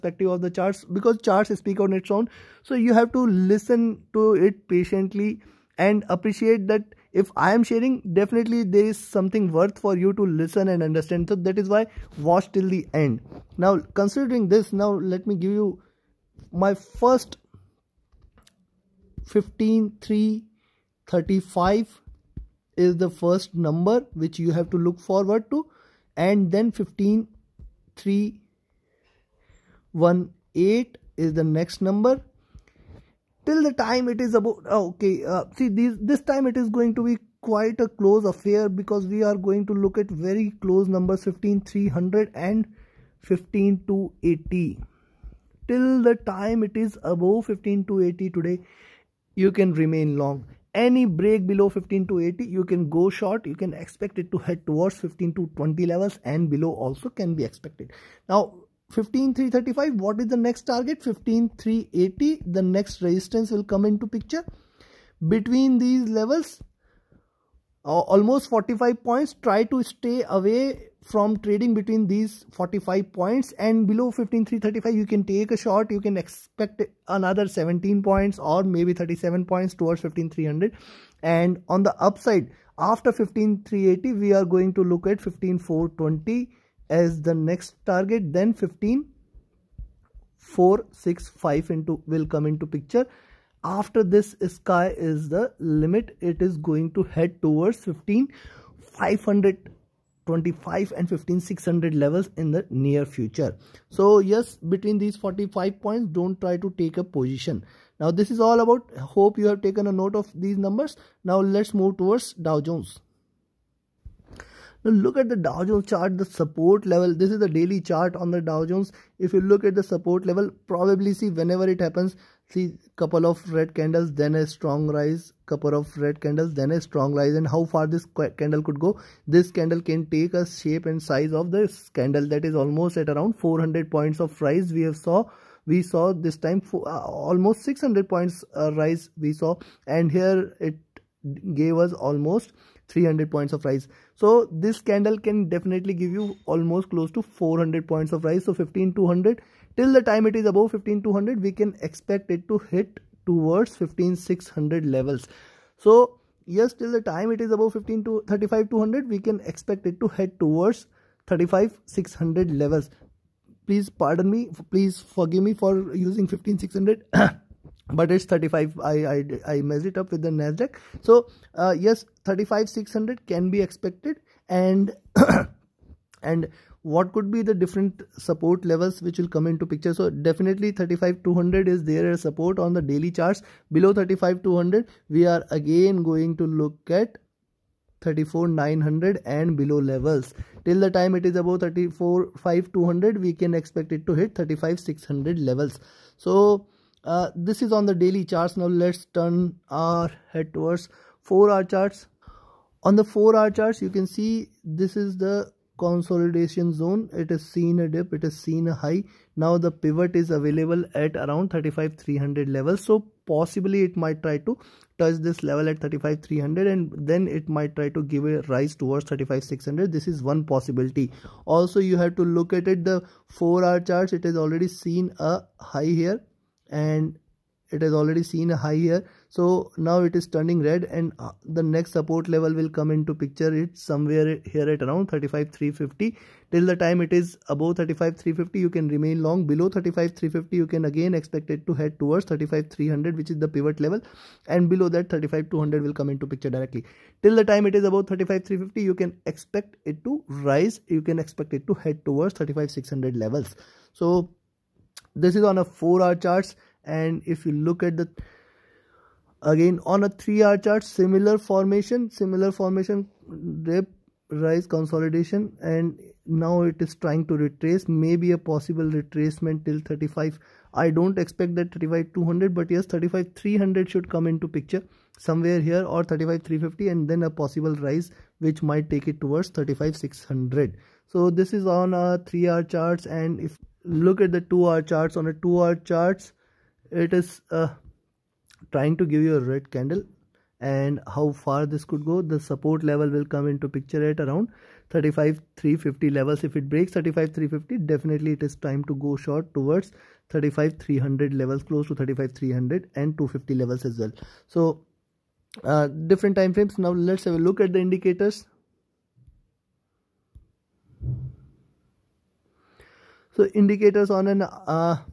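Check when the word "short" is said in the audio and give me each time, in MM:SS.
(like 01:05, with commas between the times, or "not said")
00:53, 01:15, 04:59.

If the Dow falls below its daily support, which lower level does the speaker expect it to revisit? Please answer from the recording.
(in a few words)
34900.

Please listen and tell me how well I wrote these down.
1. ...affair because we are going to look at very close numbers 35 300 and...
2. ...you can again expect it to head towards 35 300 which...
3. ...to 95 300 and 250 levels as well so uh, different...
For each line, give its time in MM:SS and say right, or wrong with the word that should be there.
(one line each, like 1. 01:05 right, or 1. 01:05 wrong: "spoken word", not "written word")
1. 00:38 wrong: "15", not "35"
2. 04:00 right
3. 05:01 wrong: "35", not "95".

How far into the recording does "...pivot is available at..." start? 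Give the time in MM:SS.
03:29.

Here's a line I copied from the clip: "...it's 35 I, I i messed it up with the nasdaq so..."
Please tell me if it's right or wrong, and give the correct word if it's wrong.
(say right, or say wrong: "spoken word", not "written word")
right.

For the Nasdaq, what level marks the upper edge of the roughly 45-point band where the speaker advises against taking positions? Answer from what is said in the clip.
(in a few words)
15380.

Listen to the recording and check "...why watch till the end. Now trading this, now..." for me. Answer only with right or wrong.
wrong.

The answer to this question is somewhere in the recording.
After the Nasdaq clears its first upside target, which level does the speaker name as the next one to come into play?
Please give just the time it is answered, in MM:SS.
01:28.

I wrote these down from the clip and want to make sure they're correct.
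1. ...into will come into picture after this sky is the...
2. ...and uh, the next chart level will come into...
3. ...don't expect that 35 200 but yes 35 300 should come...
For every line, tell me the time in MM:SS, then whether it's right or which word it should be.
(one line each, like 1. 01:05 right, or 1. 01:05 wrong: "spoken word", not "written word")
1. 01:31 right
2. 03:50 wrong: "support", not "chart"
3. 04:30 right.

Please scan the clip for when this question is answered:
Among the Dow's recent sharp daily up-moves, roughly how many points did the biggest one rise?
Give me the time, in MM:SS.
02:17.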